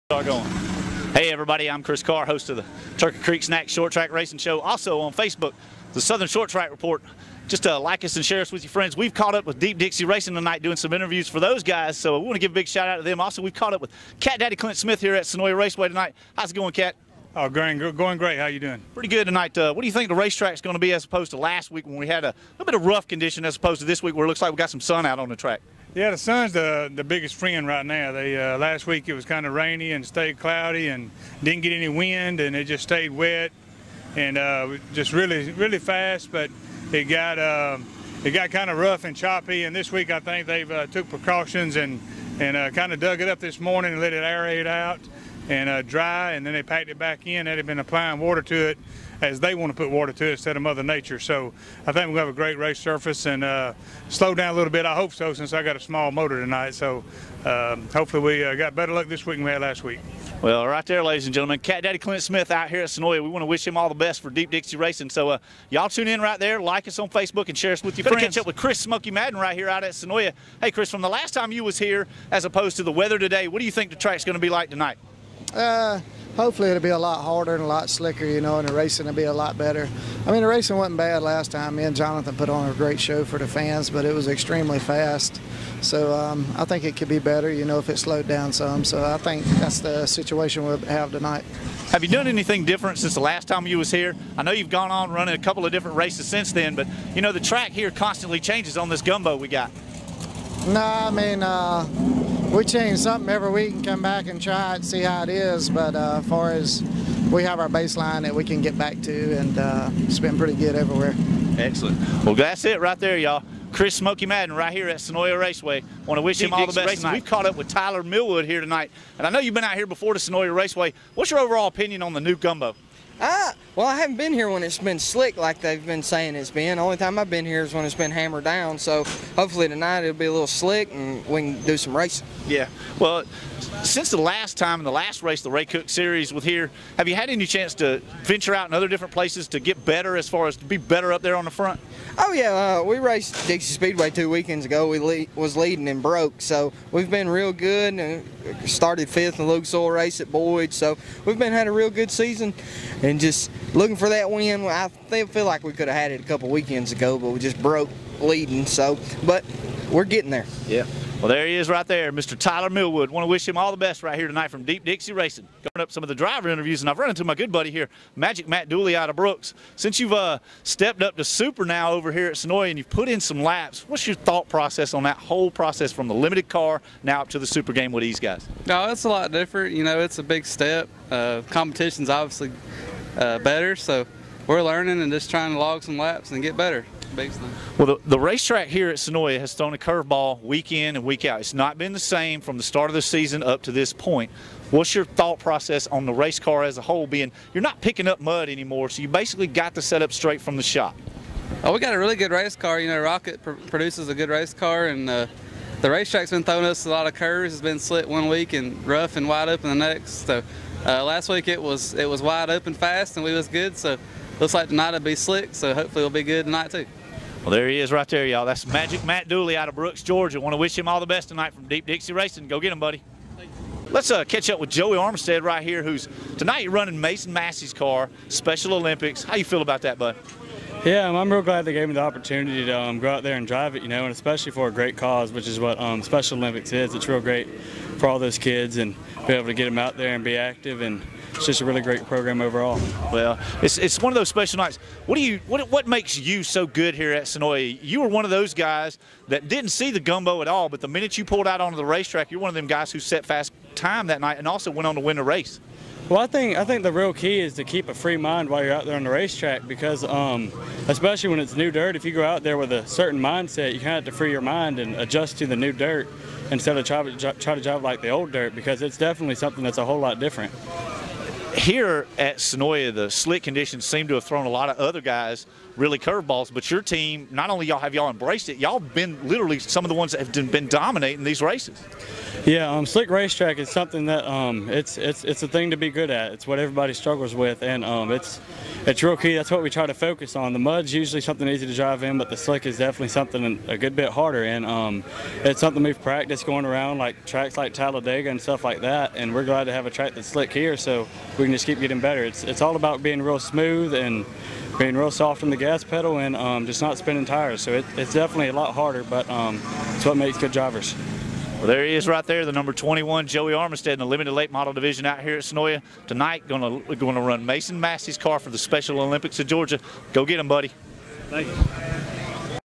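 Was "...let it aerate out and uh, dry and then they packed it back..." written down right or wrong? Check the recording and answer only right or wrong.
right.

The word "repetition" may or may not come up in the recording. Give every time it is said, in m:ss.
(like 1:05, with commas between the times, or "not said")
not said.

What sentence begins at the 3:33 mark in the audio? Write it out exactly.
So looks like tonight it'll be slick, so hopefully it'll be good tonight too.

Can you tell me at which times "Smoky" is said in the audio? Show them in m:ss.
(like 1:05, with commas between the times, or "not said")
1:08, 1:53.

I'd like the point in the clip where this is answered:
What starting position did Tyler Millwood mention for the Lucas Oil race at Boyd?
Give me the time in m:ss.
2:29.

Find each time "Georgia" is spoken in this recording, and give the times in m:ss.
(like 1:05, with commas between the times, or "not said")
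3:40, 5:19.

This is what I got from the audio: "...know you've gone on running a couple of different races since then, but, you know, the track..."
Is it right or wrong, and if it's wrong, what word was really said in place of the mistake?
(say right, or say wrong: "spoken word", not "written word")
right.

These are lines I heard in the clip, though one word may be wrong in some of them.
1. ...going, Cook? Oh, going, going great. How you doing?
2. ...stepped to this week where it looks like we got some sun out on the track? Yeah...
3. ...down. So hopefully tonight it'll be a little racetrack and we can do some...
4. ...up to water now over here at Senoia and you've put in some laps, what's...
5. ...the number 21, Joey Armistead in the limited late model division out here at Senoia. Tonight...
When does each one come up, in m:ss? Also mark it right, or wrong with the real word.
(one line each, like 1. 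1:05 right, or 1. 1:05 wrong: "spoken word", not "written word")
1. 0:16 wrong: "Cat", not "Cook"
2. 0:23 wrong: "opposed", not "stepped"
3. 2:08 wrong: "slick", not "racetrack"
4. 2:51 wrong: "super", not "water"
5. 5:12 right.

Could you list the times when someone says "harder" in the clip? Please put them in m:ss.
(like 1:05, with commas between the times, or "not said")
1:17, 4:54, 5:08.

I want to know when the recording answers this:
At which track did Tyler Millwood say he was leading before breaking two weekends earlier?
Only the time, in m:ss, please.
2:23.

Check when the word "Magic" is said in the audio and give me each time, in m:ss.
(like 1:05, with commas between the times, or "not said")
2:48, 3:38.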